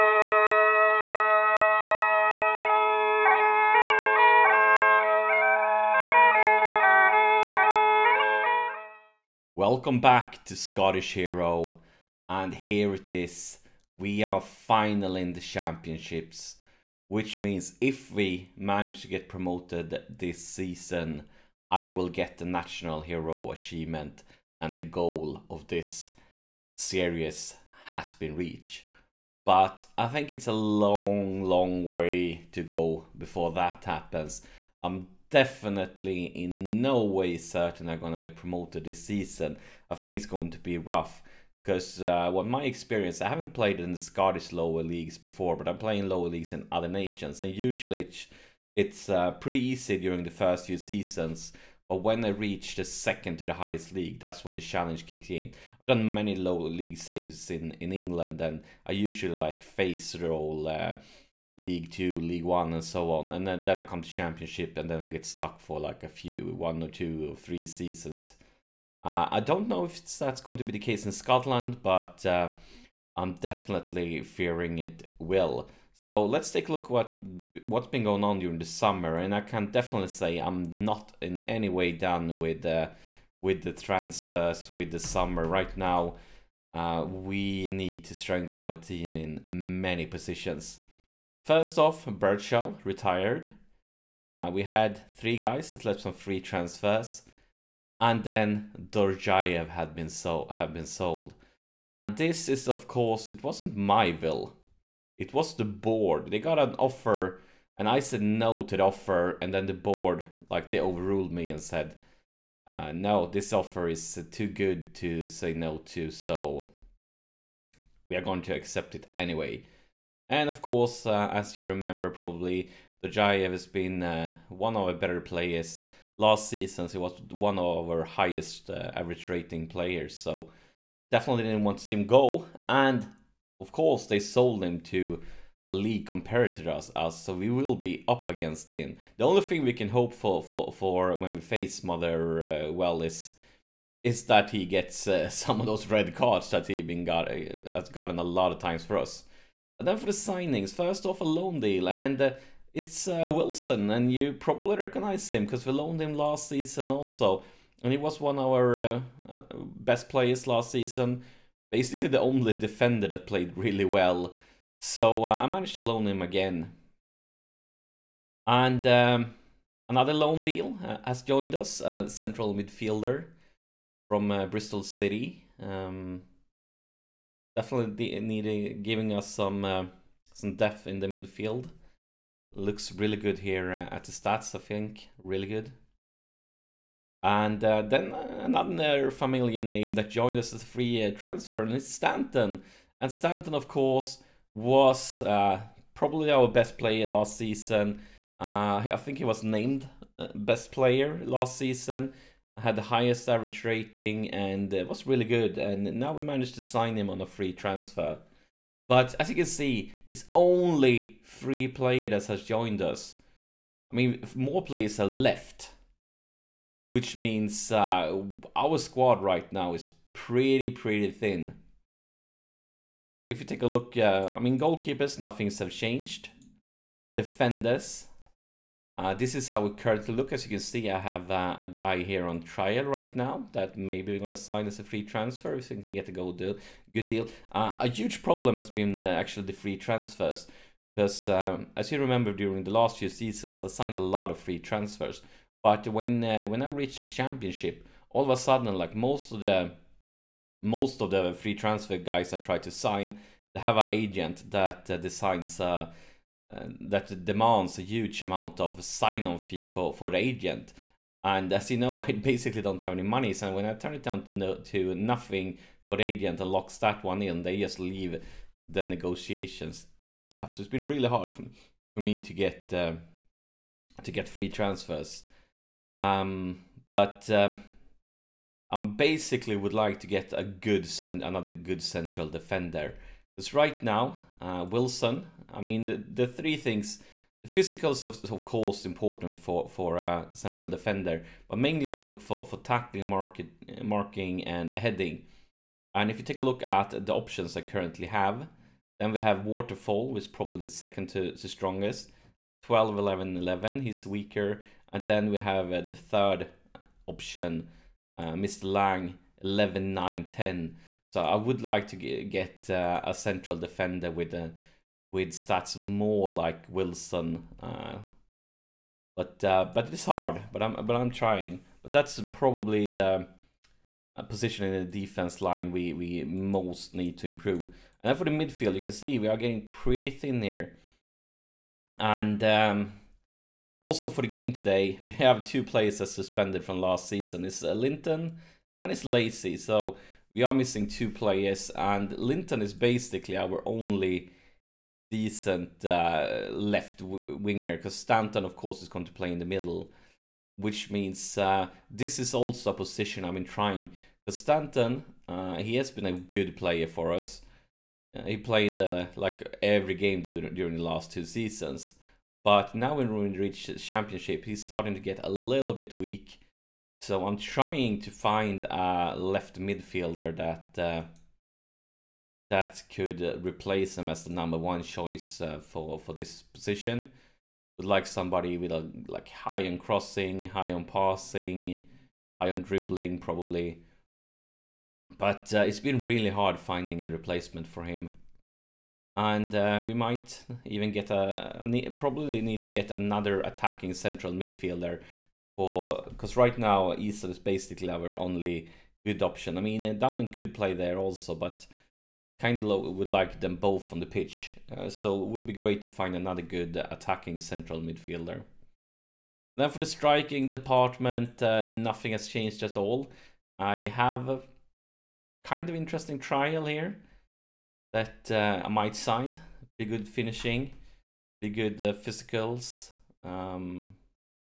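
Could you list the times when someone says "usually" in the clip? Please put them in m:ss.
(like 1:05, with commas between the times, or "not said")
0:47, 0:58.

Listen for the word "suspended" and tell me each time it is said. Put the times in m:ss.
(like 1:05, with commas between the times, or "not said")
5:36.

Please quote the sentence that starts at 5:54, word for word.
Because Stanton, uh, he has been a good player for us.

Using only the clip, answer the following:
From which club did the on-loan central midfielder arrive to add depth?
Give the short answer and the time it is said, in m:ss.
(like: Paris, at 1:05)
Bristol City, at 2:54.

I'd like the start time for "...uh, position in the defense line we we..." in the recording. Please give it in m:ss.
5:24.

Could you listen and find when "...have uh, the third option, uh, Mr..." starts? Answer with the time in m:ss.
5:05.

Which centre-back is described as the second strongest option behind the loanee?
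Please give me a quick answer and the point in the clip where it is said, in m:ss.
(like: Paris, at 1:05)
Waterfall, at 4:59.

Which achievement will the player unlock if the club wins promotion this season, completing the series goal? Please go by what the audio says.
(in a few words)
national hero.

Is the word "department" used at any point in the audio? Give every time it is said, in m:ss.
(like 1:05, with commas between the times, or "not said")
6:50.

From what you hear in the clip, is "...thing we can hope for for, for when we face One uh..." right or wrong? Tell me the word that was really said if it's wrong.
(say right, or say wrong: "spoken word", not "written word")
wrong: "Mother", not "One".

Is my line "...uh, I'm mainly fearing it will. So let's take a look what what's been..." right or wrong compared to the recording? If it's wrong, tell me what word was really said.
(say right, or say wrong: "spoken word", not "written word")
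wrong: "definitely", not "mainly".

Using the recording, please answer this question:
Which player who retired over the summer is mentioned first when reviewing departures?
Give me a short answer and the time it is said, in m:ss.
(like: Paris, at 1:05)
Birdshell, at 1:32.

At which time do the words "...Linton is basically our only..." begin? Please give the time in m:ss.
5:42.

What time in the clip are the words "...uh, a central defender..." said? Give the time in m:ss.
5:12.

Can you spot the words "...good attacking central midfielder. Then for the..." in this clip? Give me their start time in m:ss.
6:46.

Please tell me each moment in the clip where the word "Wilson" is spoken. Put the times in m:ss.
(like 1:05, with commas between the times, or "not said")
2:33, 4:44, 5:16.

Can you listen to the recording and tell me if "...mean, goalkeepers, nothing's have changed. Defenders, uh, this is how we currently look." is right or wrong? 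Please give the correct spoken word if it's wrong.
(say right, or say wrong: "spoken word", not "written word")
right.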